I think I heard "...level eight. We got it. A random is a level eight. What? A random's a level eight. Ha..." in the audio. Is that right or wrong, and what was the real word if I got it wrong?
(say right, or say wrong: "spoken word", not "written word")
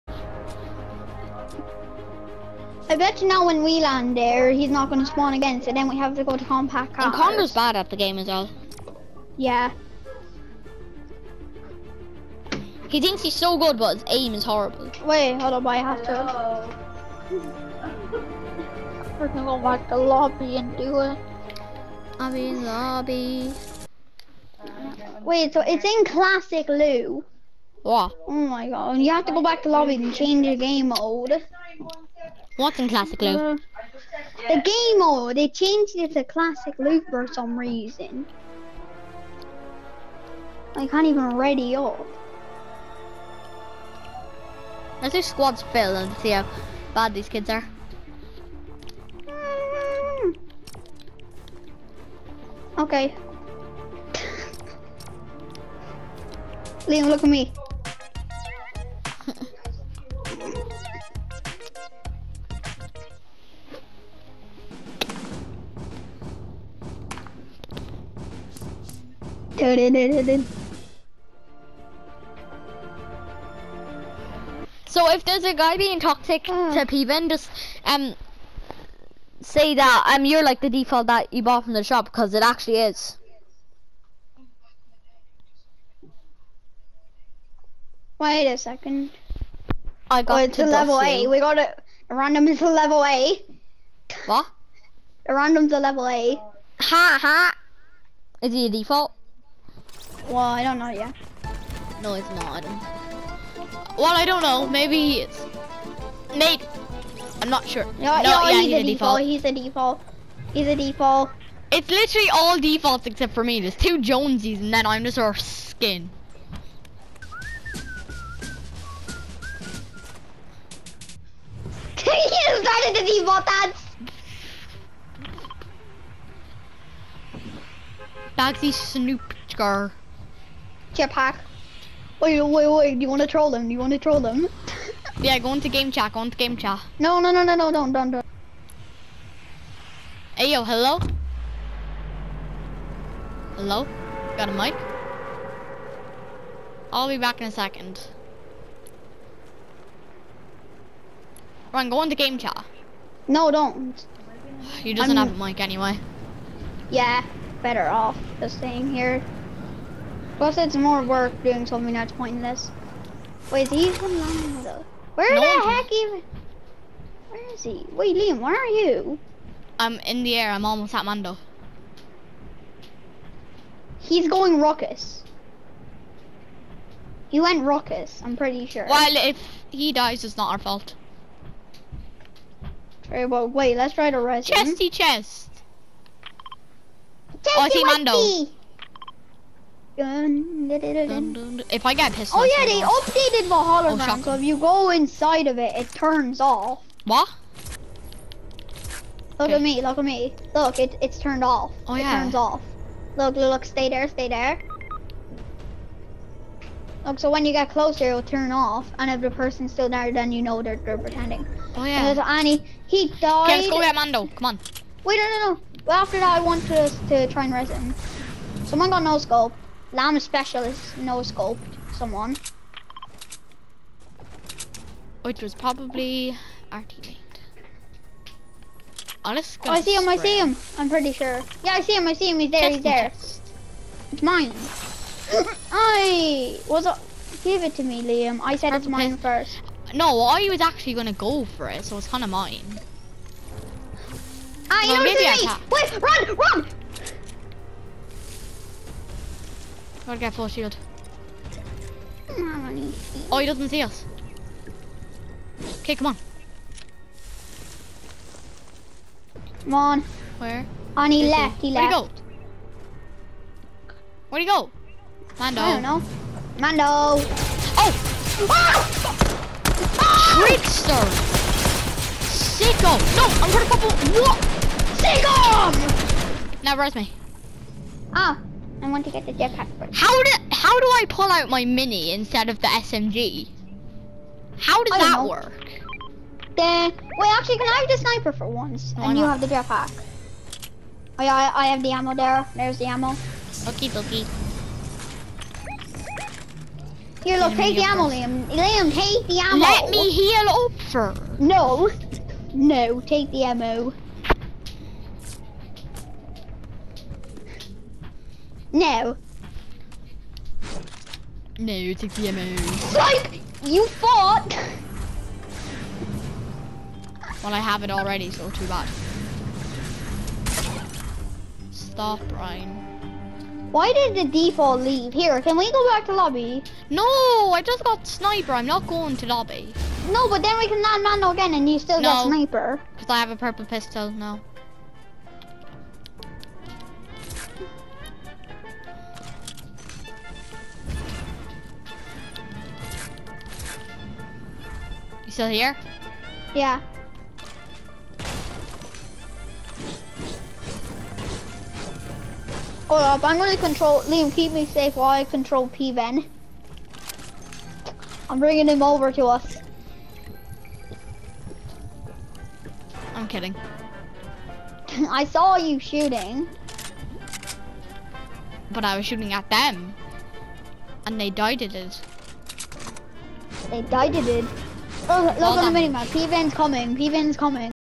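right.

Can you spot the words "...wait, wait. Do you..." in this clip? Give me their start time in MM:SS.
02:12.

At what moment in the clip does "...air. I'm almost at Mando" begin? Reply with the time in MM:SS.
02:50.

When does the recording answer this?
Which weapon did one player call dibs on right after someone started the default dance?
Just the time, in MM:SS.
02:08.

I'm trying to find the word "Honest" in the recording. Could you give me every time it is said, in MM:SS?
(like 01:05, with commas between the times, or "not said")
03:49.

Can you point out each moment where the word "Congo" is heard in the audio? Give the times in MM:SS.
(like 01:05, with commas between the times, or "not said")
00:07.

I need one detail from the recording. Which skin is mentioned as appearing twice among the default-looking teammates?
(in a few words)
Jonesies.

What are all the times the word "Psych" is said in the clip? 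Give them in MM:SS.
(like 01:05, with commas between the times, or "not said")
05:12.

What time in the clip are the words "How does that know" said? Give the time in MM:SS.
04:44.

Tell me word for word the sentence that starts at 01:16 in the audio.
to Peven, just um say that um you're like the default that you bought from the shop because it actually is.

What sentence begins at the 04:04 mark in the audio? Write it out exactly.
Ah, you maybe I Wait, run, run!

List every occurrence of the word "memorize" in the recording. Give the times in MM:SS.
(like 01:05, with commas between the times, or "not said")
not said.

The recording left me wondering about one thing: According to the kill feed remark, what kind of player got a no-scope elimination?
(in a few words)
Llama specialist.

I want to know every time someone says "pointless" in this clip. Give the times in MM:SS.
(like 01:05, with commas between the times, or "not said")
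02:42.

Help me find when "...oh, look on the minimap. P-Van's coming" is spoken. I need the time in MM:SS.
06:15.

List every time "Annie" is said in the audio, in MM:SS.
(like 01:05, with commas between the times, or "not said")
03:32.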